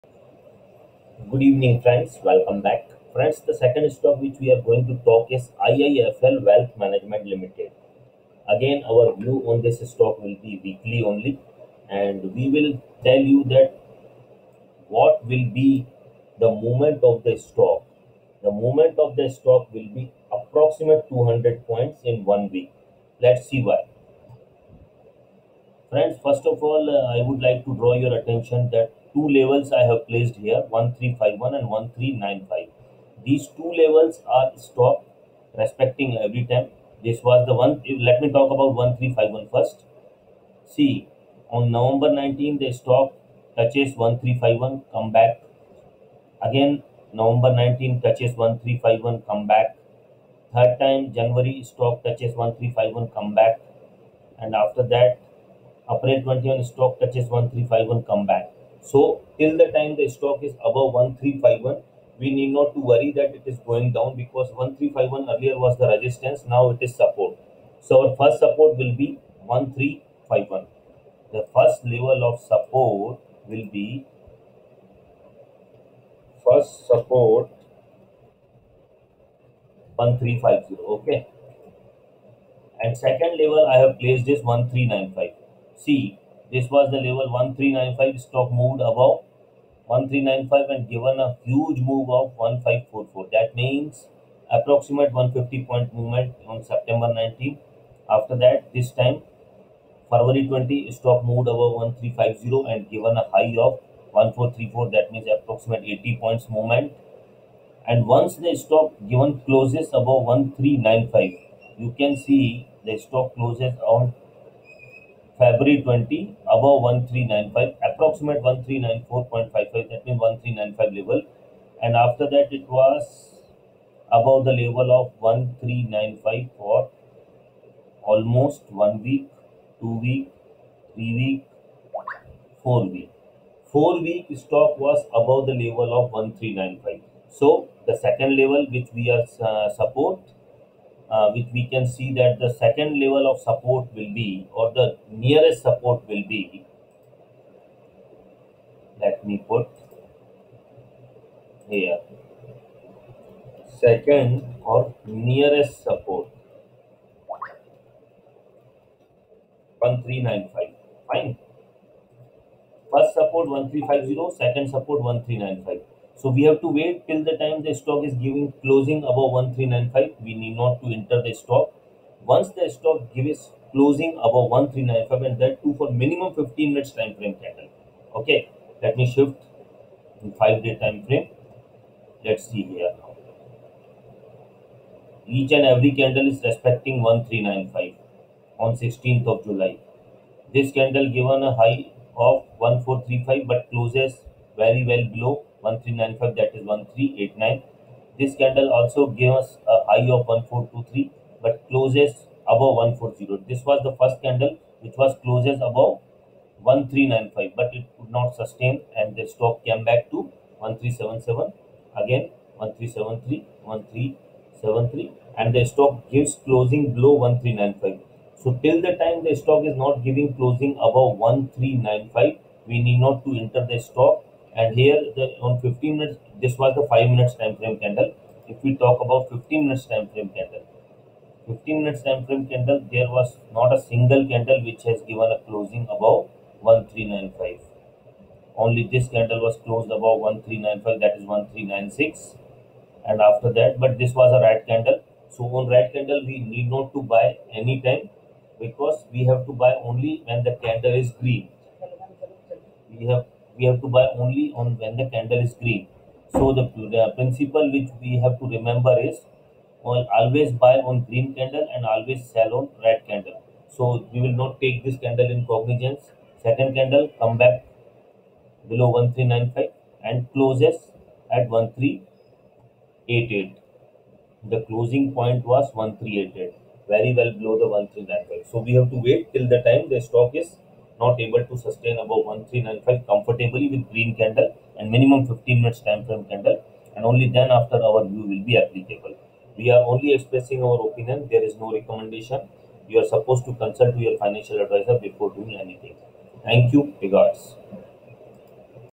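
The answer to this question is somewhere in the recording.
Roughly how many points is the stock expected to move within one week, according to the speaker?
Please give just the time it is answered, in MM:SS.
00:21.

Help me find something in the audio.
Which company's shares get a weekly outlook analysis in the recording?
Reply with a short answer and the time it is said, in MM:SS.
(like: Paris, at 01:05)
IIFL Wealth Management Limited, at 00:05.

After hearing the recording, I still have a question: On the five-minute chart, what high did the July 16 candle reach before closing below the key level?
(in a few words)
1435.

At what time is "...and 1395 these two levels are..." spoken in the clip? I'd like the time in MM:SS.
00:31.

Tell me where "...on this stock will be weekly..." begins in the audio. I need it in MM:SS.
00:09.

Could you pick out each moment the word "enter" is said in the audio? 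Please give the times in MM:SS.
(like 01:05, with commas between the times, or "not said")
02:50, 03:43.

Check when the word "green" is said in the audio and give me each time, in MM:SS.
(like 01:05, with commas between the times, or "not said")
04:11, 04:15, 04:21, 04:43.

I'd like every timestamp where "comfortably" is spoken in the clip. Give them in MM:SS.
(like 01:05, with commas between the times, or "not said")
04:43.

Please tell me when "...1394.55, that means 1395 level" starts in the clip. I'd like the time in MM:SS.
01:58.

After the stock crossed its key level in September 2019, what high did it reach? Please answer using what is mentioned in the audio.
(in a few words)
1544.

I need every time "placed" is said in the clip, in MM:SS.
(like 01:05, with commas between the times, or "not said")
00:30, 01:23.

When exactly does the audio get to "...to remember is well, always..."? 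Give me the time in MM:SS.
04:18.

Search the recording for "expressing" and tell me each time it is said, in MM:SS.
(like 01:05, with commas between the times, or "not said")
04:50.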